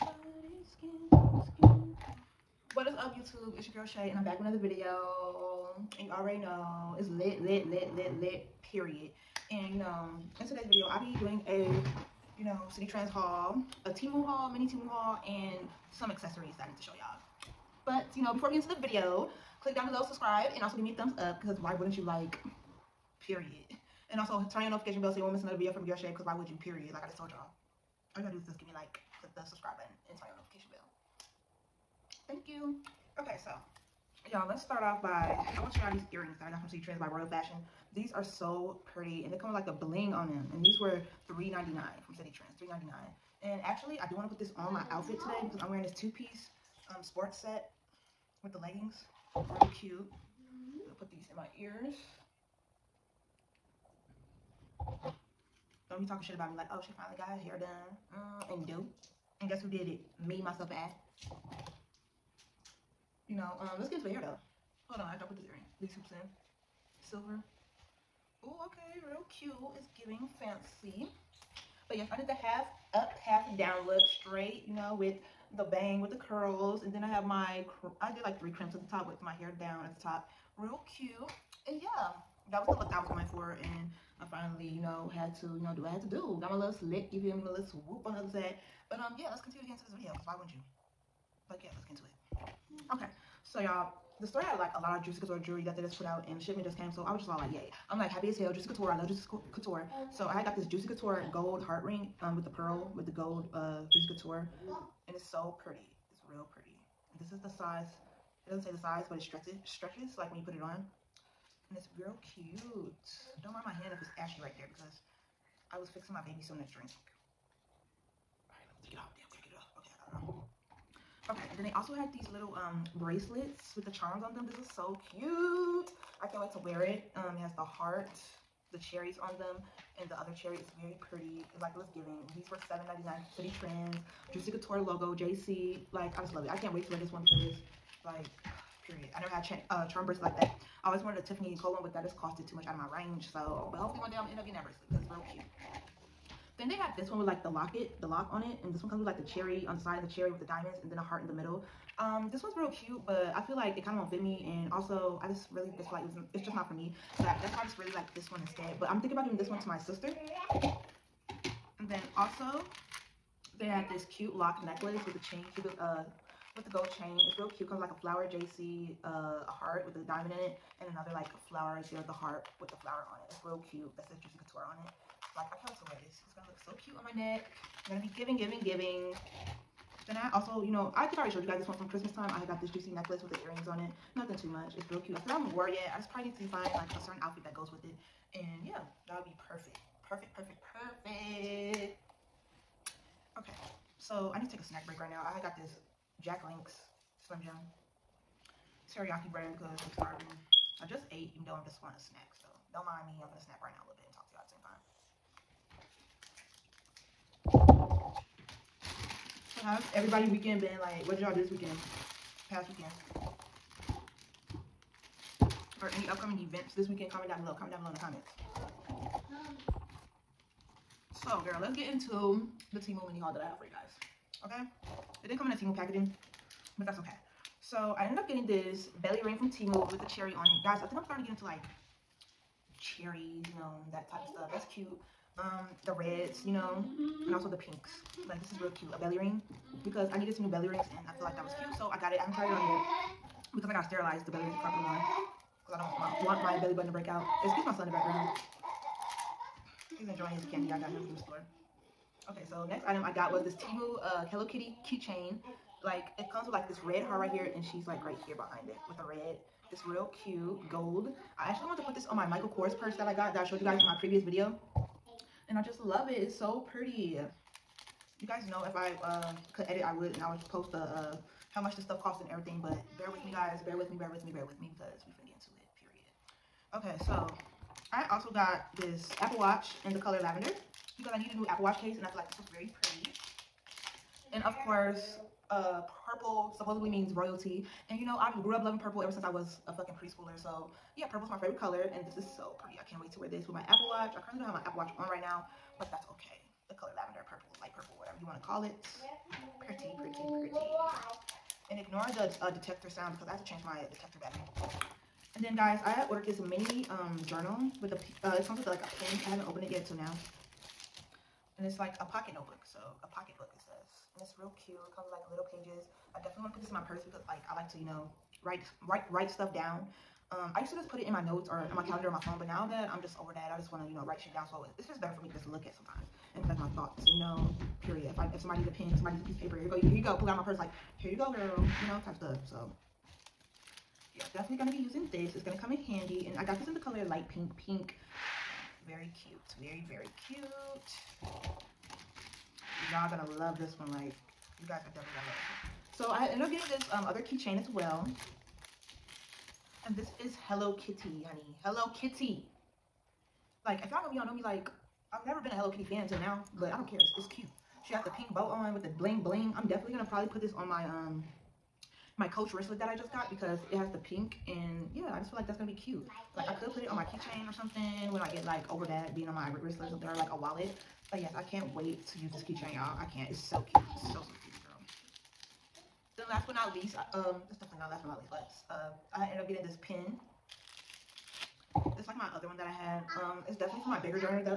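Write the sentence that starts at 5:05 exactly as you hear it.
And then guys, I ordered this mini um, journal with the, uh, it comes with like a pen.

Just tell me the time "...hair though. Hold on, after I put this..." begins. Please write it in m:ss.
1:04.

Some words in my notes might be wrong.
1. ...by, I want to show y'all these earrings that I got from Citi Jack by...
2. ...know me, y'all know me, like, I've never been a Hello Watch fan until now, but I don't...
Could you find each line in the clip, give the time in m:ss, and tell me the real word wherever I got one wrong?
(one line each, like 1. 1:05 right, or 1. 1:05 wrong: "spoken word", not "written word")
1. 0:35 wrong: "Trends", not "Jack"
2. 5:54 wrong: "Kitty", not "Watch".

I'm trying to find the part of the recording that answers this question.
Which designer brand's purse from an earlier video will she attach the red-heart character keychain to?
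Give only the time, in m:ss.
4:22.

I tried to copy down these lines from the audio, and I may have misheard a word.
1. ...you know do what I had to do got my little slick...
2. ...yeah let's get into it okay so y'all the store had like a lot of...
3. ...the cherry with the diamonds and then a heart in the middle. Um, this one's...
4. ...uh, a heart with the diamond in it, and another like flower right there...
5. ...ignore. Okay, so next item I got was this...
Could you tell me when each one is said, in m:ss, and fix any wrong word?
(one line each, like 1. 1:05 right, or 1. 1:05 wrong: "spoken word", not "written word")
1. 1:25 right
2. 1:31 right
3. 2:30 right
4. 2:49 right
5. 4:11 wrong: "store", not "ignore".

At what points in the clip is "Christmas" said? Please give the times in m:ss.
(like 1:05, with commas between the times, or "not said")
3:01.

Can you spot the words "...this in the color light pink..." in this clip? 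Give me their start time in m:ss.
5:36.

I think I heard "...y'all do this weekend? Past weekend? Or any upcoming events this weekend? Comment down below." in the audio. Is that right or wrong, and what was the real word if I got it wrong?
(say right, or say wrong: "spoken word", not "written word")
right.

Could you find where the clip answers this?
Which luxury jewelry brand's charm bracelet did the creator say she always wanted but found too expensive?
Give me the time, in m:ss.
2:21.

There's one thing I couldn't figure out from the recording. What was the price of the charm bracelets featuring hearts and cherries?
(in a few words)
$7.99.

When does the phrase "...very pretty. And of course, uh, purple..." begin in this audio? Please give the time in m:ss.
4:42.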